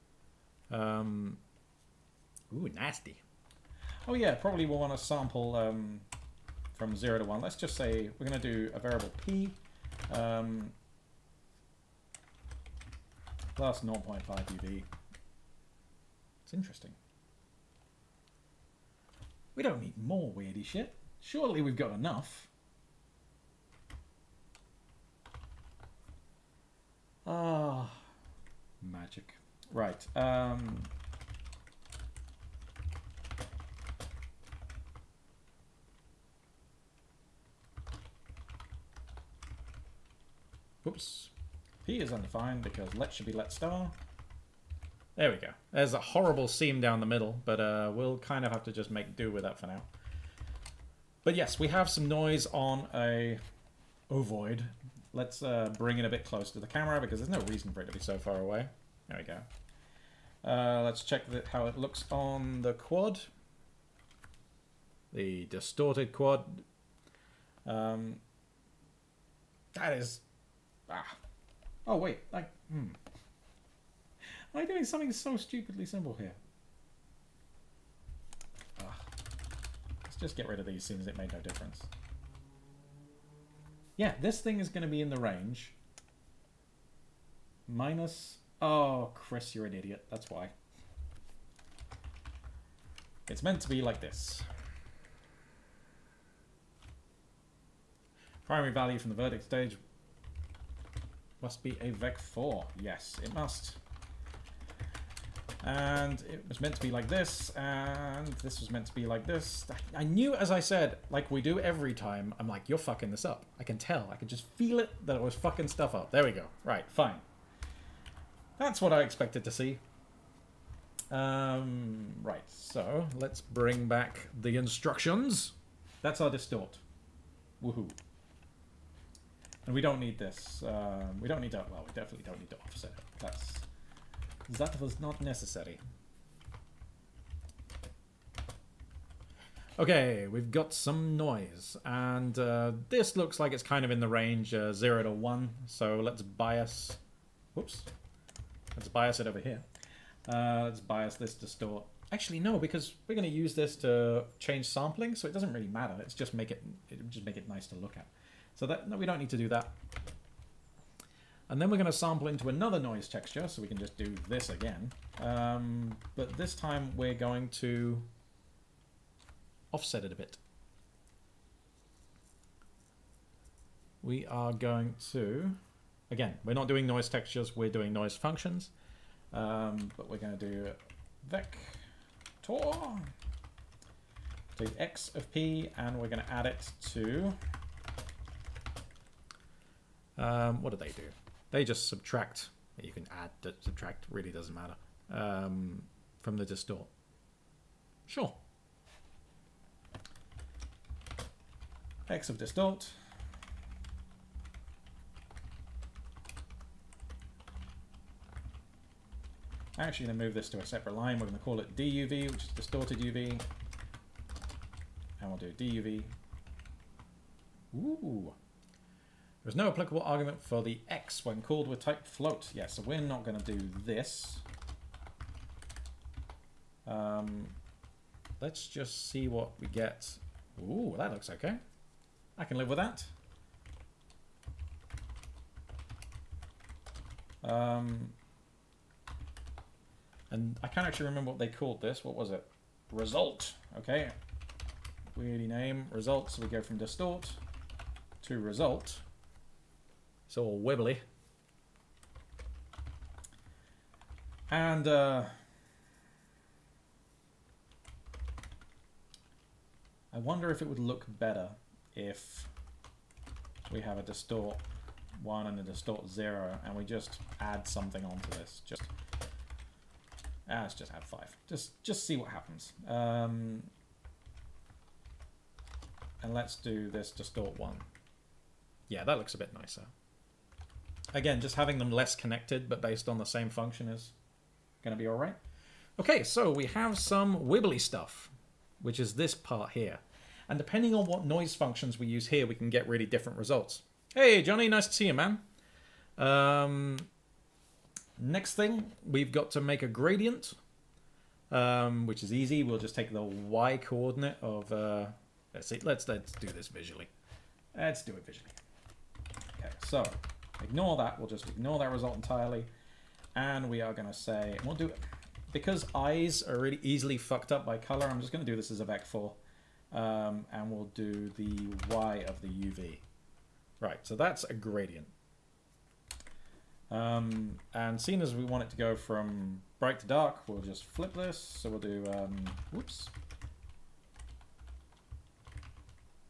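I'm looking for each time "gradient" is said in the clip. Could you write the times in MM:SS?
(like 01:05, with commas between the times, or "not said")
04:59, 05:24.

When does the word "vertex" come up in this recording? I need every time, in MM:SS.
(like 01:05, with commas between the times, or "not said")
01:39.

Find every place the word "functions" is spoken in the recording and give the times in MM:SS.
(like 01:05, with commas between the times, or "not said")
02:58, 04:43, 04:51.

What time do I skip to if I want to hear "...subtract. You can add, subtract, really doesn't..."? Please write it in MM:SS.
03:11.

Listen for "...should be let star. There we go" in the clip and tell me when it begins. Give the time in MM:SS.
00:43.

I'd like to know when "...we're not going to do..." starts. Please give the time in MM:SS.
03:42.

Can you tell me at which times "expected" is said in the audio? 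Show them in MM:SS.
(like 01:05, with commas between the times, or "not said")
01:59.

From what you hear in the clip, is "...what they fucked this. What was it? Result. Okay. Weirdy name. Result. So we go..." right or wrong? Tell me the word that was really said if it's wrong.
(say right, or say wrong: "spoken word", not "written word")
wrong: "called", not "fucked".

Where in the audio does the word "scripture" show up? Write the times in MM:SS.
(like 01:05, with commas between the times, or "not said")
not said.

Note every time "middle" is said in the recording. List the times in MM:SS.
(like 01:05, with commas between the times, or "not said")
00:47.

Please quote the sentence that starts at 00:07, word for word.
Let's just say we're going to do a variable p um, plus 0.5 uv.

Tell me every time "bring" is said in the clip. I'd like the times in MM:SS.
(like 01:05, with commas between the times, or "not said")
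00:55, 02:03.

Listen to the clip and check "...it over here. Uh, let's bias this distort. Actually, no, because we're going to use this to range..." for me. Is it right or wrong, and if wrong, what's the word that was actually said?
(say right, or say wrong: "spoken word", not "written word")
wrong: "change", not "range".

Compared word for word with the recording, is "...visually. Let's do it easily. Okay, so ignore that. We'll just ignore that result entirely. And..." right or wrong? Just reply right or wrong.
wrong.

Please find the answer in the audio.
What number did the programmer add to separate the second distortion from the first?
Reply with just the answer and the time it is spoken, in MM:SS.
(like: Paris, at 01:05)
5, at 04:31.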